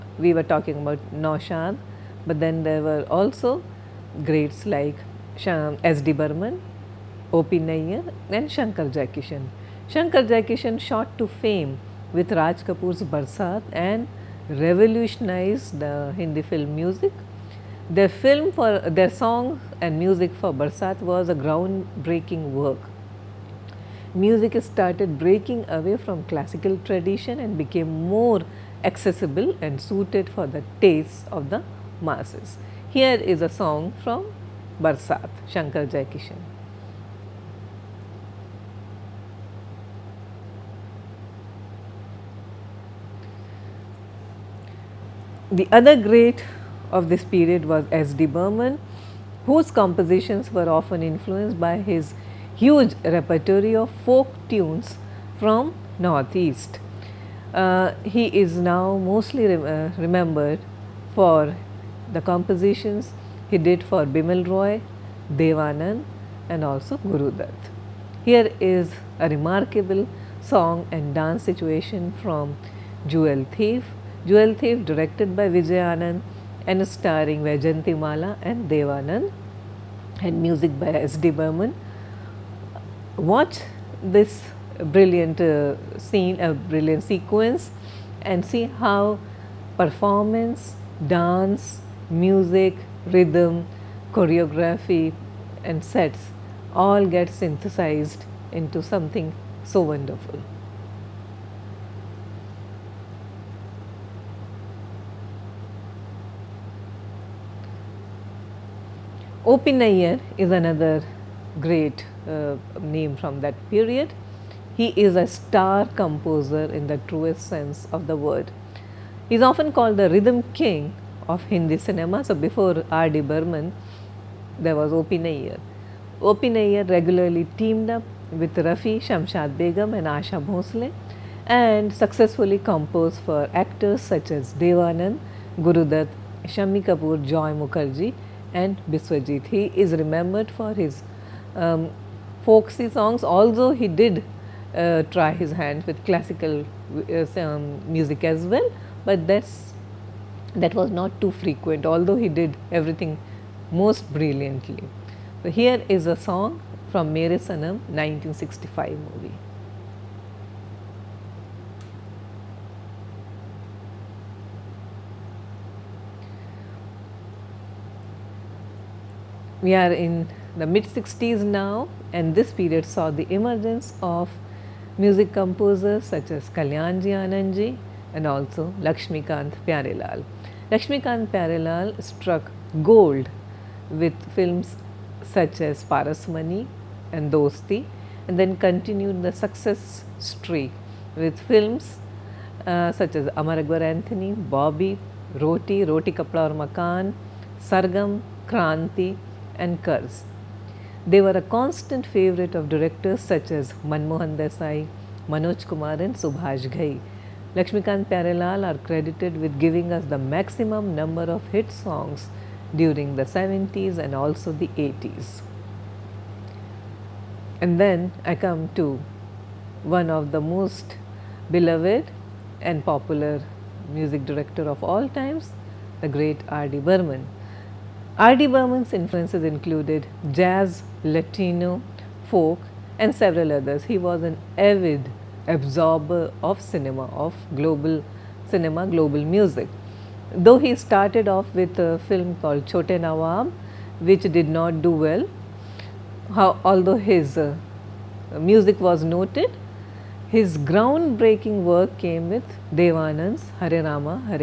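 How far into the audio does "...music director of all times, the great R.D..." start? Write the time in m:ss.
3:43.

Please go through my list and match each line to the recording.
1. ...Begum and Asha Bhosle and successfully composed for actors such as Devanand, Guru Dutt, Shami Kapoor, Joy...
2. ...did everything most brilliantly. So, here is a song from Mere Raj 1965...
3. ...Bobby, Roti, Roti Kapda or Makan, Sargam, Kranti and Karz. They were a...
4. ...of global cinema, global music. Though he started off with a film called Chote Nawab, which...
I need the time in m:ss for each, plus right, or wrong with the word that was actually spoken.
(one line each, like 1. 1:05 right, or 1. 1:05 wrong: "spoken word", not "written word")
1. 2:09 right
2. 2:32 wrong: "Sanam", not "Raj"
3. 3:14 right
4. 3:57 right.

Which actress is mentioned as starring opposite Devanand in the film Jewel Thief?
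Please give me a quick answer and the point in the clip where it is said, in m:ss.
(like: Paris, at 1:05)
Vaijayanti Mala, at 1:17.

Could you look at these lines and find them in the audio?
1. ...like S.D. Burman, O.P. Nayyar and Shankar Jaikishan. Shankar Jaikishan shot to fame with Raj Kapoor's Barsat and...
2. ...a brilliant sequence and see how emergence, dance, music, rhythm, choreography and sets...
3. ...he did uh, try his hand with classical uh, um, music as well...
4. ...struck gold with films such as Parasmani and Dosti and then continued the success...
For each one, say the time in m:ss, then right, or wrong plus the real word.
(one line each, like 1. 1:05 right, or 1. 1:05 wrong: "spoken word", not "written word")
1. 0:04 right
2. 1:26 wrong: "performance", not "emergence"
3. 2:23 right
4. 3:02 right.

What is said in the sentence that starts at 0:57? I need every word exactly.
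Uh, he is now mostly rem uh, remembered for the compositions he did for Bimal Roy, Devanand and also Guru Dutt.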